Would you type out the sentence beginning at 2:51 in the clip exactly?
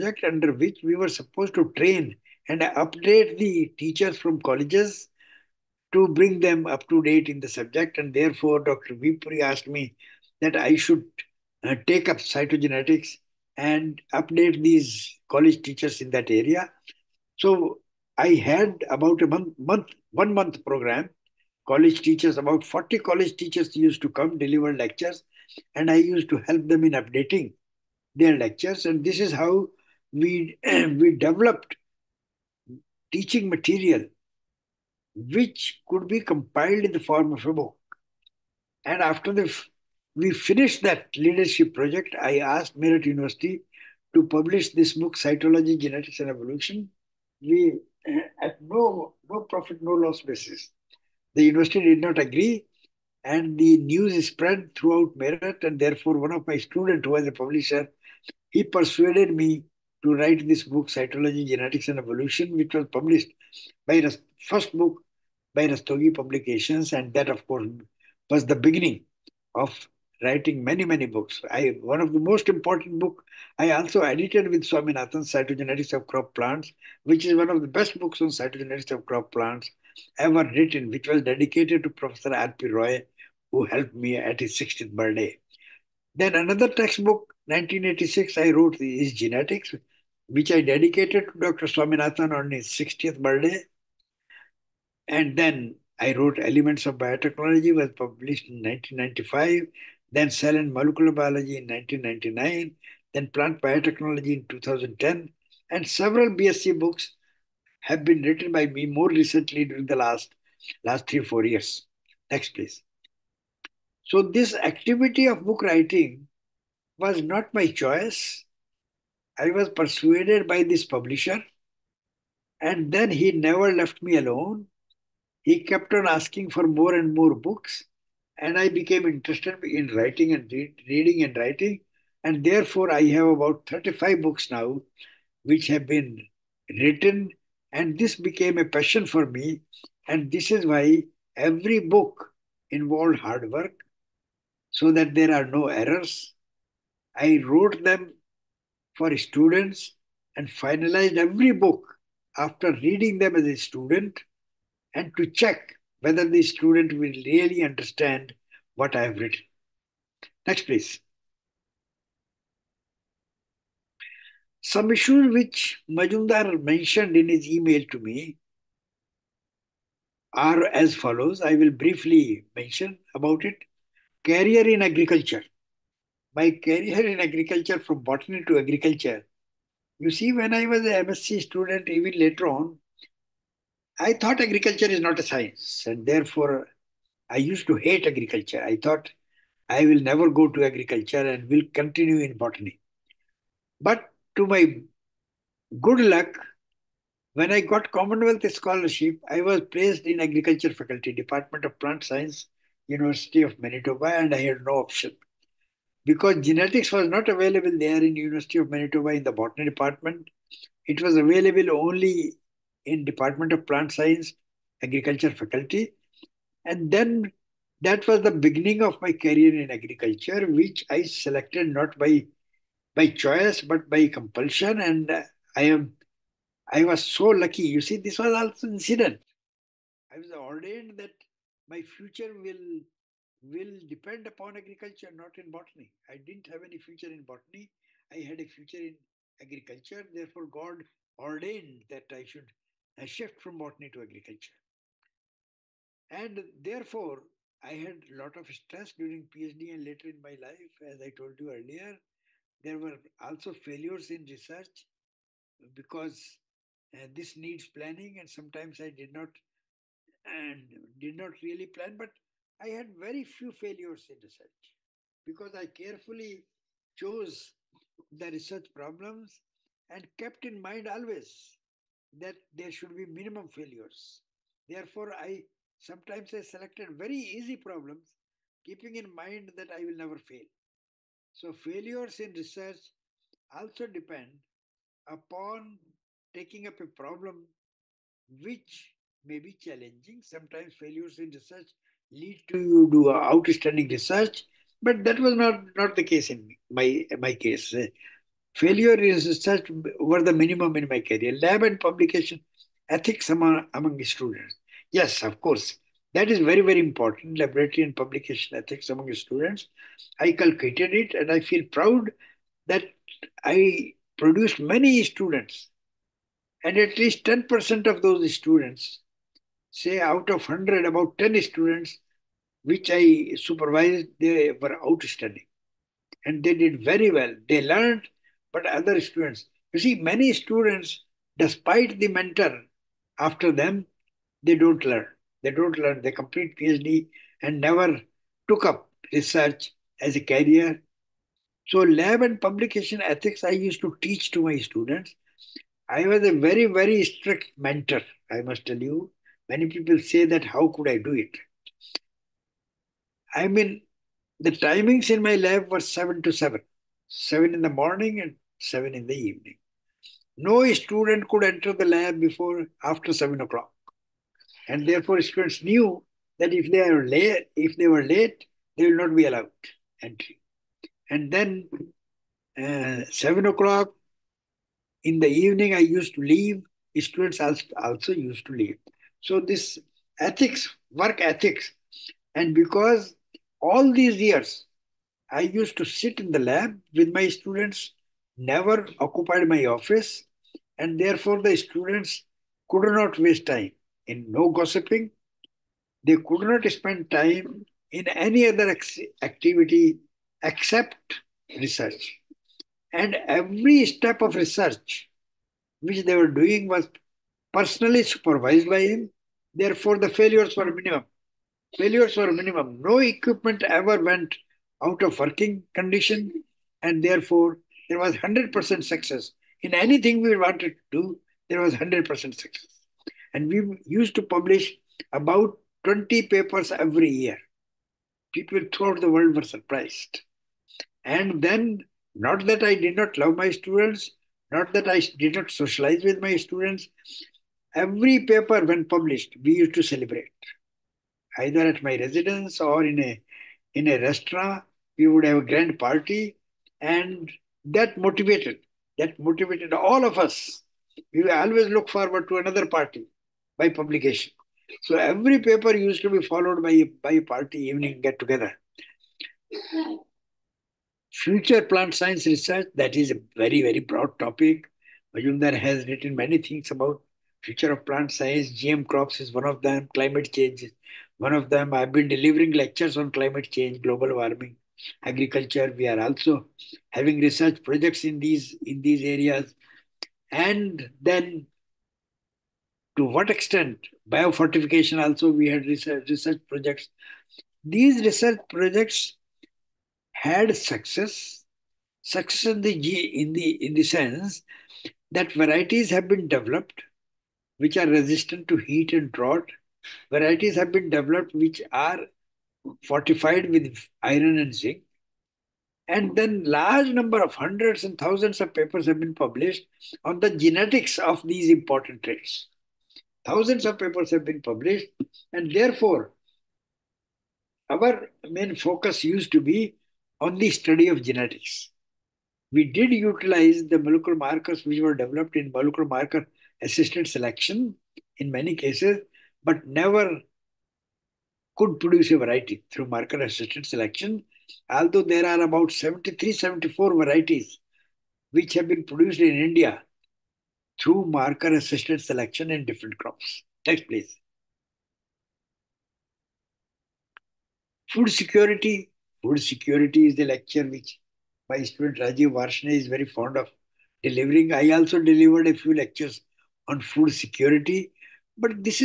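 I will briefly mention about it.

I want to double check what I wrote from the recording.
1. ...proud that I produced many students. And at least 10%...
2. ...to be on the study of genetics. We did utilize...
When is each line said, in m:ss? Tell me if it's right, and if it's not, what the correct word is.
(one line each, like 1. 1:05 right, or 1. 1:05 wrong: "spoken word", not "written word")
1. 5:11 right
2. 8:39 right.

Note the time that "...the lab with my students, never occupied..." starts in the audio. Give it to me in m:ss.
6:26.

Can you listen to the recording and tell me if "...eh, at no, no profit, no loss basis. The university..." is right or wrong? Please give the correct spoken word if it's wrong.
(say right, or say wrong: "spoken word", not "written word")
right.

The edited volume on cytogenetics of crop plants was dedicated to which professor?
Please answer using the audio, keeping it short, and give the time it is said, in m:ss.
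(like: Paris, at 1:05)
R.P. Roy, at 1:21.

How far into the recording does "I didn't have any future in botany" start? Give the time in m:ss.
3:56.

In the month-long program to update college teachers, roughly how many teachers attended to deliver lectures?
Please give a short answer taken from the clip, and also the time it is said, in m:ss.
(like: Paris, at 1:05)
40, at 0:22.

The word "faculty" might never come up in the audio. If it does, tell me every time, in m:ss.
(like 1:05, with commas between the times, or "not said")
3:20, 3:35.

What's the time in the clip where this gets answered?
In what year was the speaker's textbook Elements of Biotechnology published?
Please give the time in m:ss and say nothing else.
1:38.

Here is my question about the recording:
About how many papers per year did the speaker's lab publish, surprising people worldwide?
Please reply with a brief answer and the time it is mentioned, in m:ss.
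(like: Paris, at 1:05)
20, at 7:05.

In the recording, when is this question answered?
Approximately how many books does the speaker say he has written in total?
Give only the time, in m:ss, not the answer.
2:13.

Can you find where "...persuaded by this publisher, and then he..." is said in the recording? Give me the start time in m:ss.
1:59.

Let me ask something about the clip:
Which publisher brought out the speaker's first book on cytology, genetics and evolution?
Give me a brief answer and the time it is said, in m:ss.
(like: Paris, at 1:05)
Rastogi Publications, at 1:05.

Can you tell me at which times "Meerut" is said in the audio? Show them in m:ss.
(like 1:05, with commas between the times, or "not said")
0:42, 0:55.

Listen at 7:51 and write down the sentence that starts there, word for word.
I've been delivering lectures on climate change, global warming, agriculture.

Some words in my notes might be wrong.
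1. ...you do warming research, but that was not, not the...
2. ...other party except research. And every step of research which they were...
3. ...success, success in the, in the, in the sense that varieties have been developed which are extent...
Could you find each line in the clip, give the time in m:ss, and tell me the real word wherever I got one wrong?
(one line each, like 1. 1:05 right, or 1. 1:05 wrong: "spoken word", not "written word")
1. 4:52 wrong: "outstanding", not "warming"
2. 6:38 wrong: "activity", not "party"
3. 8:10 wrong: "resistant", not "extent".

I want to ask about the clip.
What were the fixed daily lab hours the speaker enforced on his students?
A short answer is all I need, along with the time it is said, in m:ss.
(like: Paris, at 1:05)
7 to 7, at 5:55.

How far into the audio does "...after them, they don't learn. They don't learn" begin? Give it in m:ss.
5:33.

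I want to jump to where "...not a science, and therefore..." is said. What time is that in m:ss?
3:05.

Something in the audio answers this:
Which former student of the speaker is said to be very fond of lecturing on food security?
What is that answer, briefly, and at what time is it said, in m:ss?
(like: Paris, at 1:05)
Rajeev Varshney, at 9:11.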